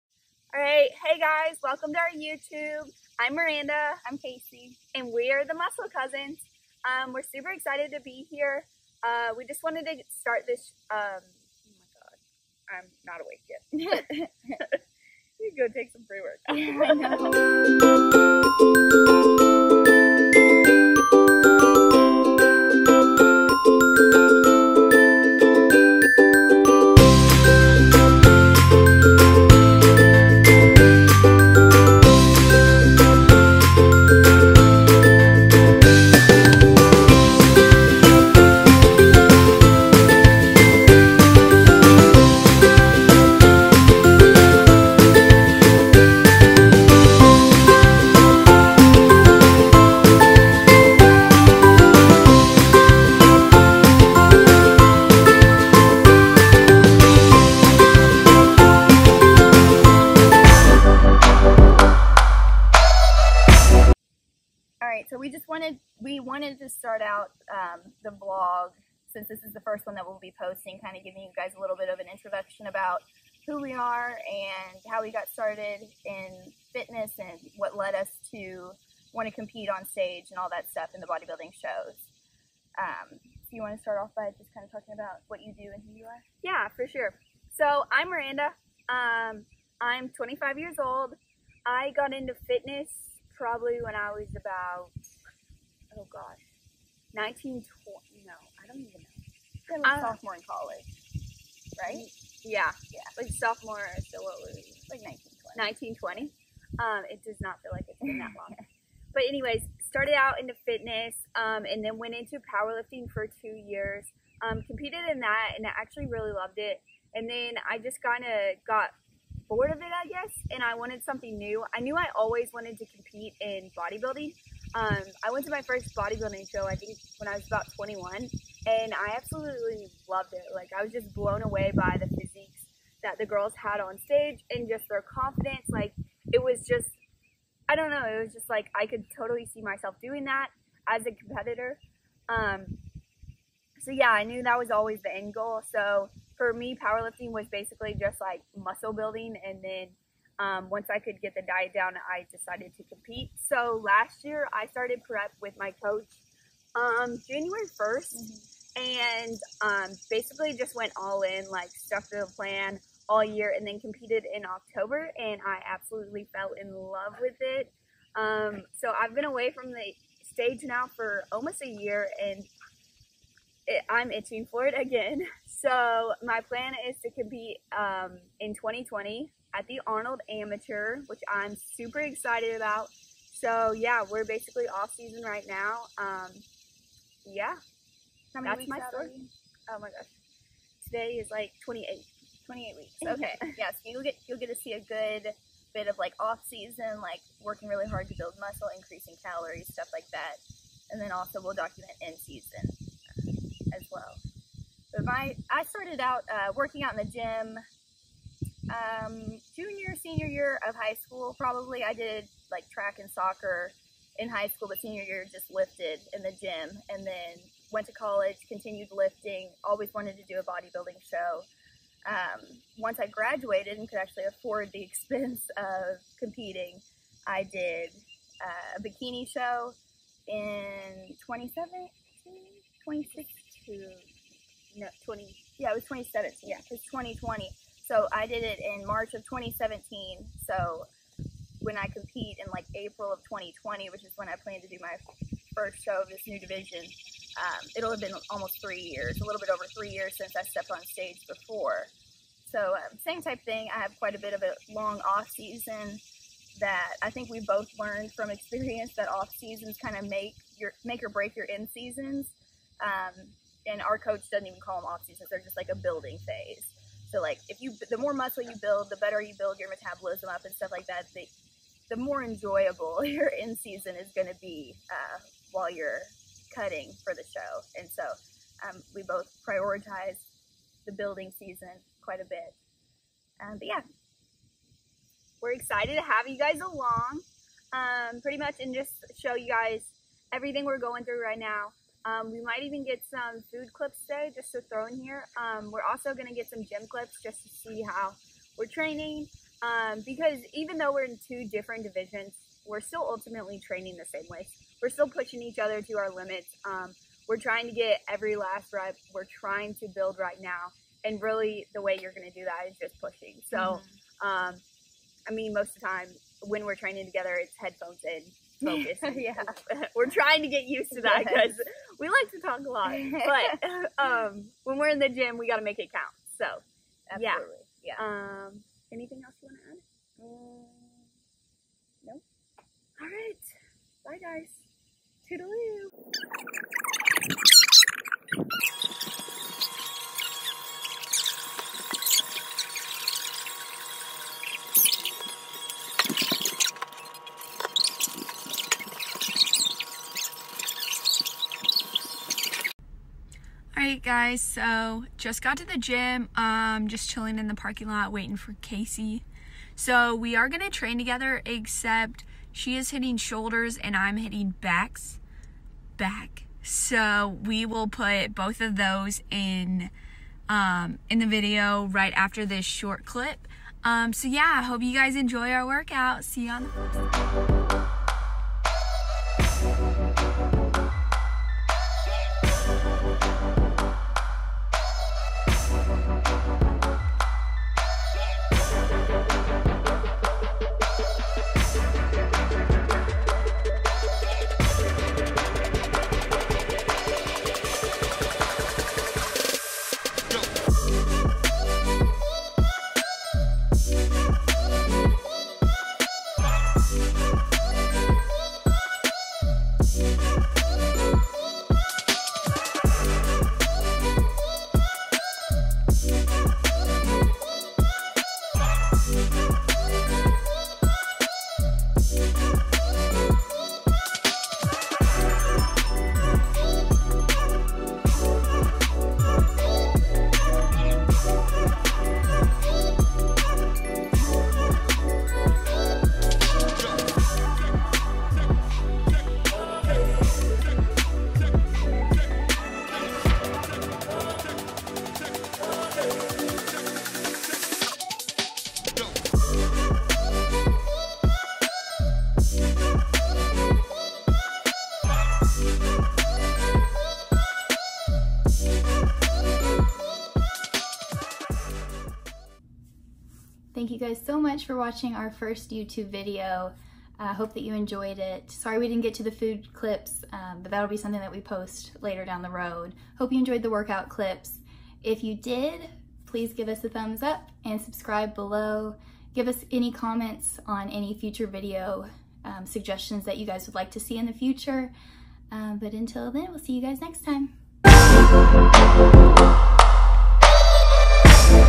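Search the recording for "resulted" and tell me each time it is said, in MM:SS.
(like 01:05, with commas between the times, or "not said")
not said.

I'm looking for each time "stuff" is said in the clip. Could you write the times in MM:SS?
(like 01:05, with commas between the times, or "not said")
01:20, 03:19, 04:30.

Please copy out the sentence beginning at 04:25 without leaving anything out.
They're just like a building phase.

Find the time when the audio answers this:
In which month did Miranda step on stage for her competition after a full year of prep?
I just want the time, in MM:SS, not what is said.
02:44.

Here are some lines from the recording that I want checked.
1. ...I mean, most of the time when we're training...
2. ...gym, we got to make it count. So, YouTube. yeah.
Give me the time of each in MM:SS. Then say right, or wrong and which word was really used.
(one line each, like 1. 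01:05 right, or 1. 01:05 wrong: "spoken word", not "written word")
1. 05:15 right
2. 05:25 wrong: "Absolutely", not "YouTube".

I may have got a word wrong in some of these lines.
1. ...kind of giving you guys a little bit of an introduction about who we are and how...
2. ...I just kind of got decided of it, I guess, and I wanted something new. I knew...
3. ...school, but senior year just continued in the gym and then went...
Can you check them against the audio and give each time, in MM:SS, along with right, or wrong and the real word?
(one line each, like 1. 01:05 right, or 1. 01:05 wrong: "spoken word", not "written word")
1. 01:10 right
2. 01:57 wrong: "bored", not "decided"
3. 03:34 wrong: "lifted", not "continued".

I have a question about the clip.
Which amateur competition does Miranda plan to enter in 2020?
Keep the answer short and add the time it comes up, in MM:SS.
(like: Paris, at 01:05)
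Arnold Amateur, at 02:59.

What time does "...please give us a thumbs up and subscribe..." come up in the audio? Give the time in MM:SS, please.
07:56.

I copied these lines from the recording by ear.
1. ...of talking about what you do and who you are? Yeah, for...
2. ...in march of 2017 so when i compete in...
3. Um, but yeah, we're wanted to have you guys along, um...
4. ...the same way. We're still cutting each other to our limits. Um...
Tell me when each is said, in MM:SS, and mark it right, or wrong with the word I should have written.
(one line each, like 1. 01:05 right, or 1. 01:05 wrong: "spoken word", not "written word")
1. 01:24 right
2. 03:58 right
3. 04:43 wrong: "excited", not "wanted"
4. 05:03 wrong: "pushing", not "cutting".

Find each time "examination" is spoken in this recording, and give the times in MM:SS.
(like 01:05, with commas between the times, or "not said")
not said.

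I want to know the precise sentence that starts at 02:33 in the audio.
So last year, I started prep with my coach um, January 1st mm-hmm.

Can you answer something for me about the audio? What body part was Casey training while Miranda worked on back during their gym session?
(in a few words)
shoulders.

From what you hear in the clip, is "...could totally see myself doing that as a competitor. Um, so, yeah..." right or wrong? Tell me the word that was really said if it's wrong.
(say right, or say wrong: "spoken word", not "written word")
right.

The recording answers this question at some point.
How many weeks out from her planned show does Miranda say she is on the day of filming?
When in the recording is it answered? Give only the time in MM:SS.
03:12.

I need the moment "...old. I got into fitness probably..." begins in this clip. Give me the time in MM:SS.
01:30.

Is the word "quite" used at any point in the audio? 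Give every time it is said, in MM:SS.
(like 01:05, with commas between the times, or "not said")
04:13, 04:42.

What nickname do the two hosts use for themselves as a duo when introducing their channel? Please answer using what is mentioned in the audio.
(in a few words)
Muscle Cousins.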